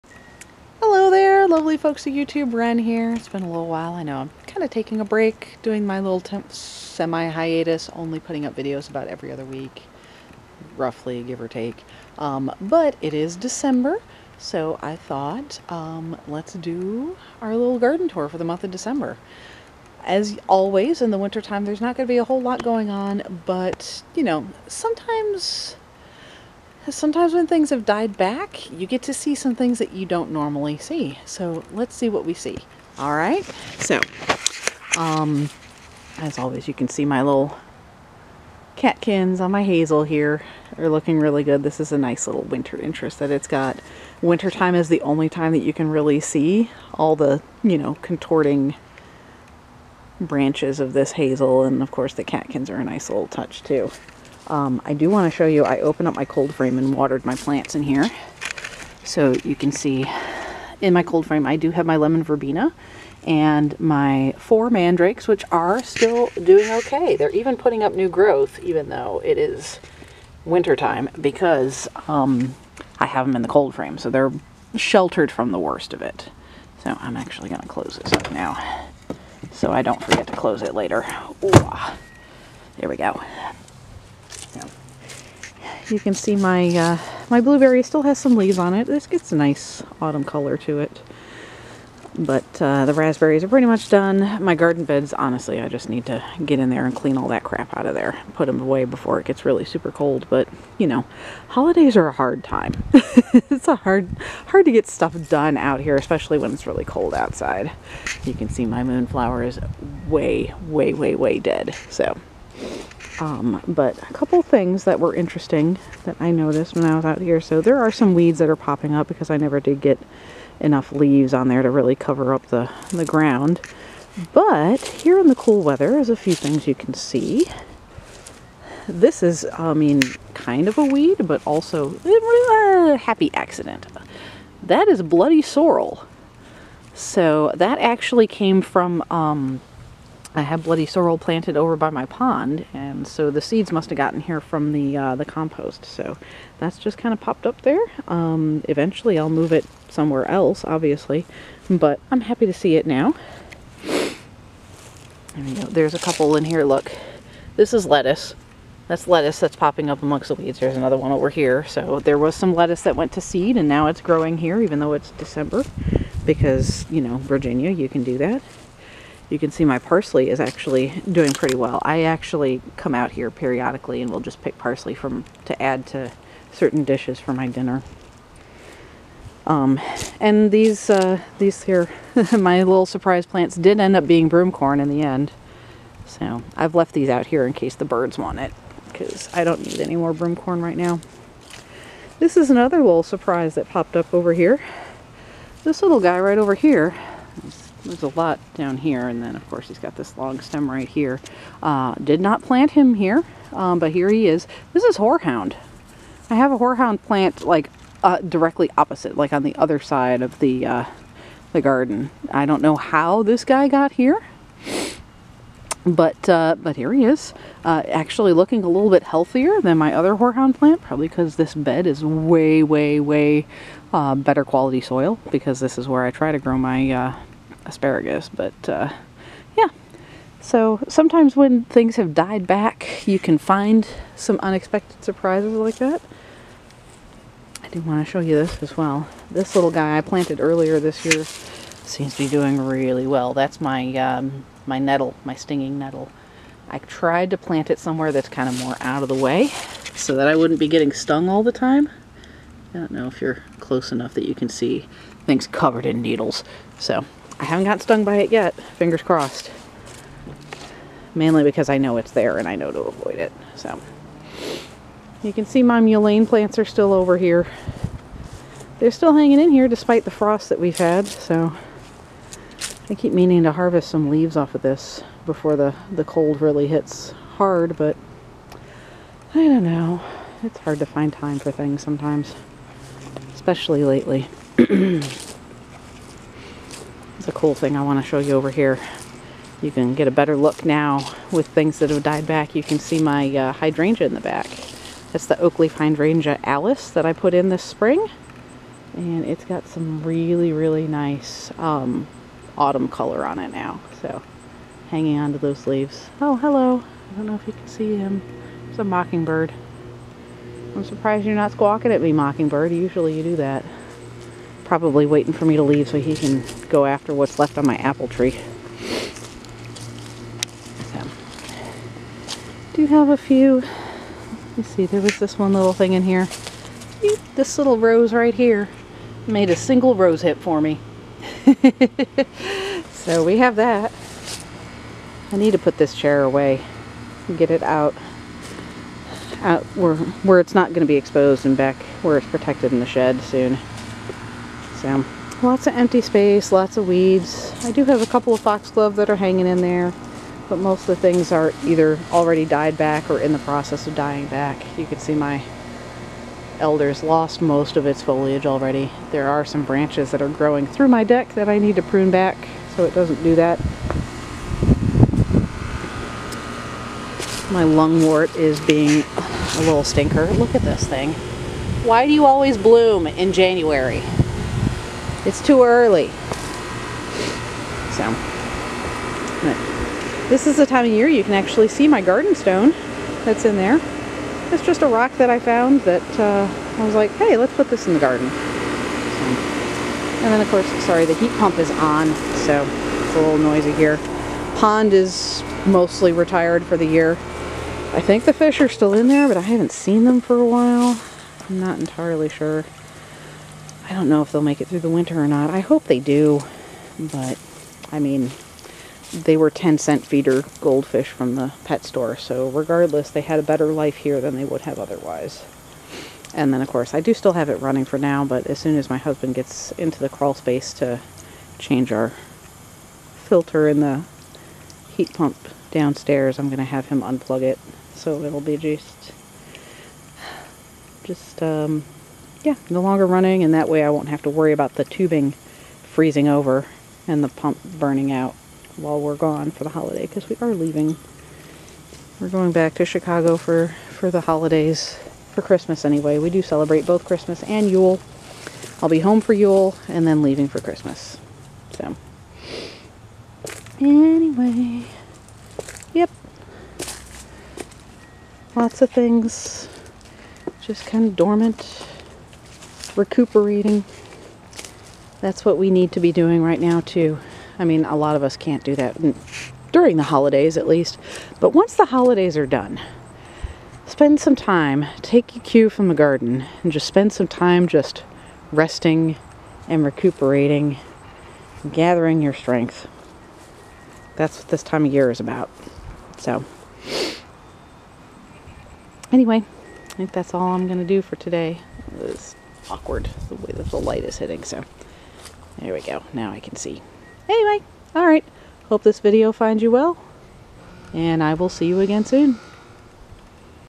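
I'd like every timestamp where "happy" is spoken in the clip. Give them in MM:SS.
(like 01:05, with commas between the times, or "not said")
02:12, 02:32.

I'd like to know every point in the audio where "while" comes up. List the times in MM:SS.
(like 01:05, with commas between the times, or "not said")
00:03, 06:40, 07:18.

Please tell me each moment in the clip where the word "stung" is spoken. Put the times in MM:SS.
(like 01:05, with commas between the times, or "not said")
04:10, 04:17.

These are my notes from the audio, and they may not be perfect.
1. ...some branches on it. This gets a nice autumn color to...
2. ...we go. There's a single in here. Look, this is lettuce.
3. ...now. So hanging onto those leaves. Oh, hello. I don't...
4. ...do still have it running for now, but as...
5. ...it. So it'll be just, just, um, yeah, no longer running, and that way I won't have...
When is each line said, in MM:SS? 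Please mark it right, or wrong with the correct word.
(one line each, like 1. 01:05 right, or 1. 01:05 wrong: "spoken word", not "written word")
1. 01:28 wrong: "leaves", not "branches"
2. 02:35 wrong: "couple", not "single"
3. 05:03 right
4. 06:57 right
5. 07:07 right.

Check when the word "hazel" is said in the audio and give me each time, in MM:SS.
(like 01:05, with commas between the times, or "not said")
00:39, 00:51.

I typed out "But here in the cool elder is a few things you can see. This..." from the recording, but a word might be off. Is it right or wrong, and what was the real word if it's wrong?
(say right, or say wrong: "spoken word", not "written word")
wrong: "weather", not "elder".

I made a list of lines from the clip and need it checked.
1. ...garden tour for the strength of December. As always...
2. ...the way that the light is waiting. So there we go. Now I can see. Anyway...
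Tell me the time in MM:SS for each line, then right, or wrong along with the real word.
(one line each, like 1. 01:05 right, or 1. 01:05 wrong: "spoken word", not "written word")
1. 00:17 wrong: "month", not "strength"
2. 08:13 wrong: "hitting", not "waiting".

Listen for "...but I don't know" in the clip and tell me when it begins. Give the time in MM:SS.
04:37.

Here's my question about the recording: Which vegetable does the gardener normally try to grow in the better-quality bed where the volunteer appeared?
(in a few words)
asparagus.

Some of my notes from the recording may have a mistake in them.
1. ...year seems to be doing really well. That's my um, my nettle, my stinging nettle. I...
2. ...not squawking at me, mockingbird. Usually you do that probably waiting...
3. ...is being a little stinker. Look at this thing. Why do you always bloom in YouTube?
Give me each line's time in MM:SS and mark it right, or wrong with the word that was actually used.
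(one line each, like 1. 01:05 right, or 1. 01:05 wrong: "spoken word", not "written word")
1. 04:01 right
2. 05:11 right
3. 06:08 wrong: "January", not "YouTube".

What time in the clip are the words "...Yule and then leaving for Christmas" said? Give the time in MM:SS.
07:29.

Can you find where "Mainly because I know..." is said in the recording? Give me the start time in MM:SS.
04:21.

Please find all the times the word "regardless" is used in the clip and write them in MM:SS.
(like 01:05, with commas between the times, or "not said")
06:52.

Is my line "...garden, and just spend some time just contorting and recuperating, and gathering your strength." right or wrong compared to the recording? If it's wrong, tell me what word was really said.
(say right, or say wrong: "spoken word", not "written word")
wrong: "resting", not "contorting".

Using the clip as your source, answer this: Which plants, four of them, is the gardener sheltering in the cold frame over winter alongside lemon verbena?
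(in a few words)
mandrakes.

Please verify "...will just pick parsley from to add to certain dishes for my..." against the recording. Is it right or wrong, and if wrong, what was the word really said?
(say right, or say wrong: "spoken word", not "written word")
right.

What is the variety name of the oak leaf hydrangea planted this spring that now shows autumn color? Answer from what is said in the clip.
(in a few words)
Alice.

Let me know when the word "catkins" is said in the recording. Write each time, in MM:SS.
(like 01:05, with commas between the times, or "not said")
00:38, 00:52.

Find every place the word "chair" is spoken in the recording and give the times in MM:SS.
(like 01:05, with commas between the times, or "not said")
05:35.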